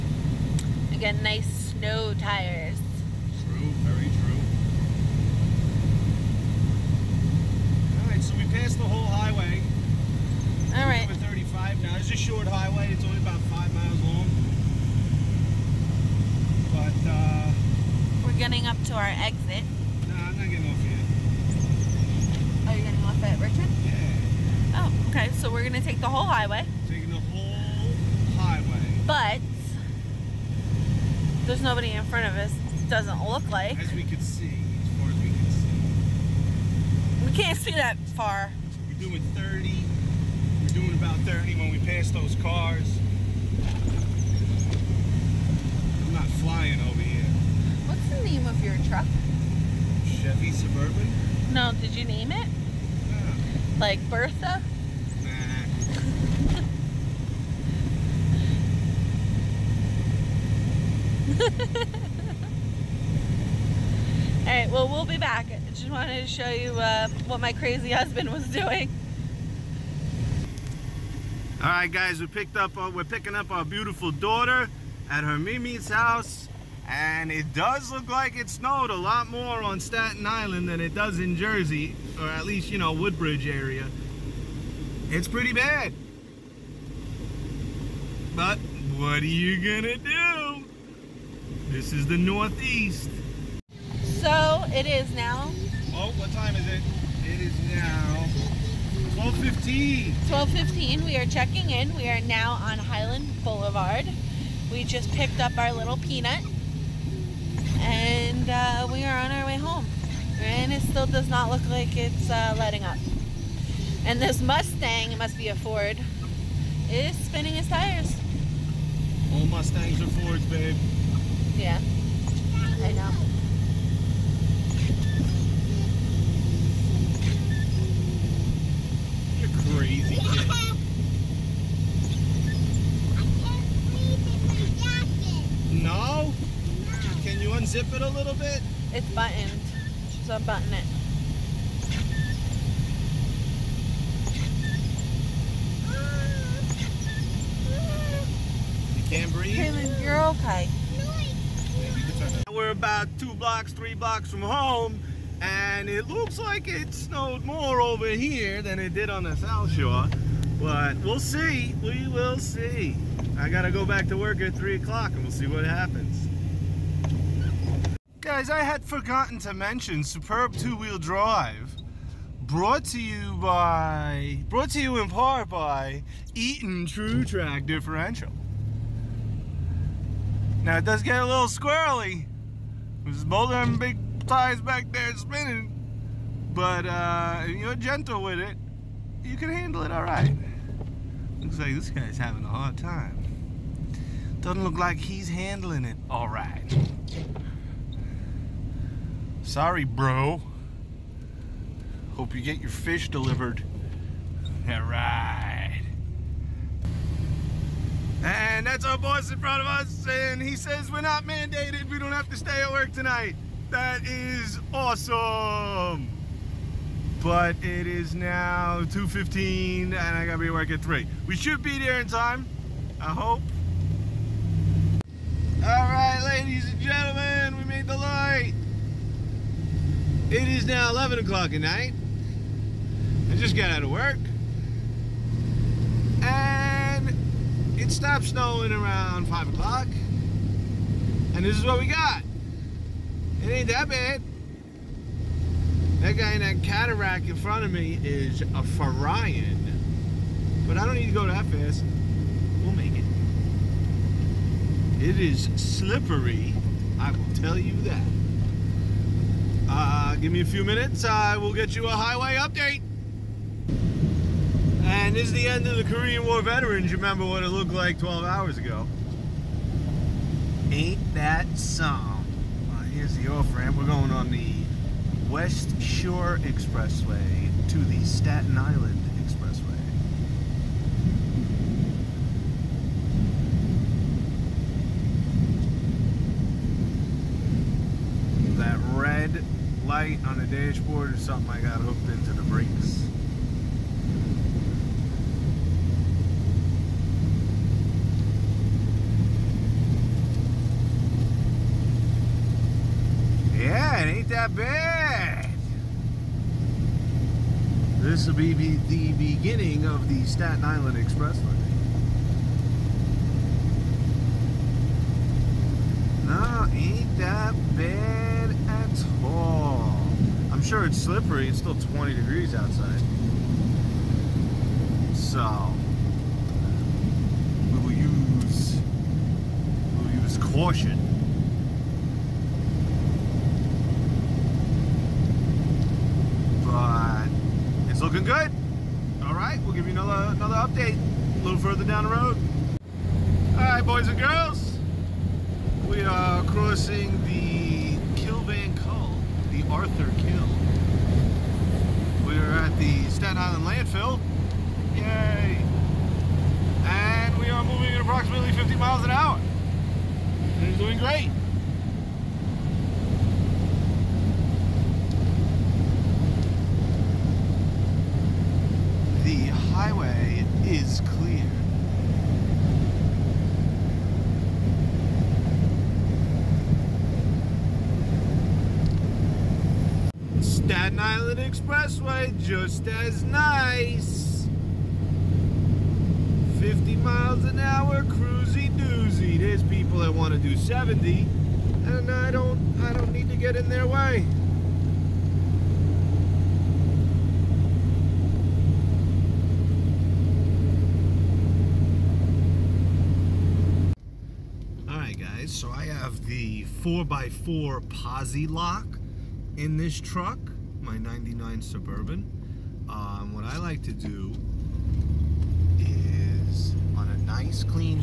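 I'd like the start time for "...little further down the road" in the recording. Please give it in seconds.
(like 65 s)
341 s.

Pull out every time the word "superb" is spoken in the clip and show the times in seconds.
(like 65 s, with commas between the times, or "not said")
170 s.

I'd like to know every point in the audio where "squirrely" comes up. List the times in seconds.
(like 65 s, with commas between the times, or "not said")
181 s.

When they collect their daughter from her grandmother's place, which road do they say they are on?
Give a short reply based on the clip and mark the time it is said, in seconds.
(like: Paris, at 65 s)
Highland Boulevard, at 102 s.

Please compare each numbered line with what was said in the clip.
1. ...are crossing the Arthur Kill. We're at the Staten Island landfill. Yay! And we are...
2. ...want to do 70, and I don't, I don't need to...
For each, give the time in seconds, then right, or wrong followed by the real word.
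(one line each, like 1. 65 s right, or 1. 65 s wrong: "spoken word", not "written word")
1. 346 s right
2. 390 s right.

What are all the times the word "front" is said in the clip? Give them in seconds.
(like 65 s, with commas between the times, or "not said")
32 s, 209 s, 247 s.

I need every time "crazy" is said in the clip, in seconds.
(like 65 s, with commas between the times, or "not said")
67 s, 129 s.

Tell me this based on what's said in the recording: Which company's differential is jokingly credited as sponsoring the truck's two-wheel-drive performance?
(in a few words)
Eaton Truetrac.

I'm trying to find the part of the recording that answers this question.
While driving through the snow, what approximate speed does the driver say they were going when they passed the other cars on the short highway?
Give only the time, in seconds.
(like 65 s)
40 s.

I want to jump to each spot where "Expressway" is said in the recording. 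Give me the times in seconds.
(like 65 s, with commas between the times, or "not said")
276 s, 310 s, 381 s.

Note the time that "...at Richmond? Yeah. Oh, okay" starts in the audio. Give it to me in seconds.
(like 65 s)
23 s.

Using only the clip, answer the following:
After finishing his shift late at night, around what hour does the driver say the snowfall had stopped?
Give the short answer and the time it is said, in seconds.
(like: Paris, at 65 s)
5 o'clock, at 239 s.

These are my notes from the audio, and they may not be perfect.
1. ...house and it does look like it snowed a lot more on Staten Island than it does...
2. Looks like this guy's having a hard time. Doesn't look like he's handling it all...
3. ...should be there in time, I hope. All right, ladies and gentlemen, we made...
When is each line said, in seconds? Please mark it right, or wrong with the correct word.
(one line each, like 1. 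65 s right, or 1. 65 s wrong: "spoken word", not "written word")
1. 75 s right
2. 191 s right
3. 221 s right.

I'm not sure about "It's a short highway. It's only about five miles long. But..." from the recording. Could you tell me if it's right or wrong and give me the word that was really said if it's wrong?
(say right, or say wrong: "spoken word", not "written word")
right.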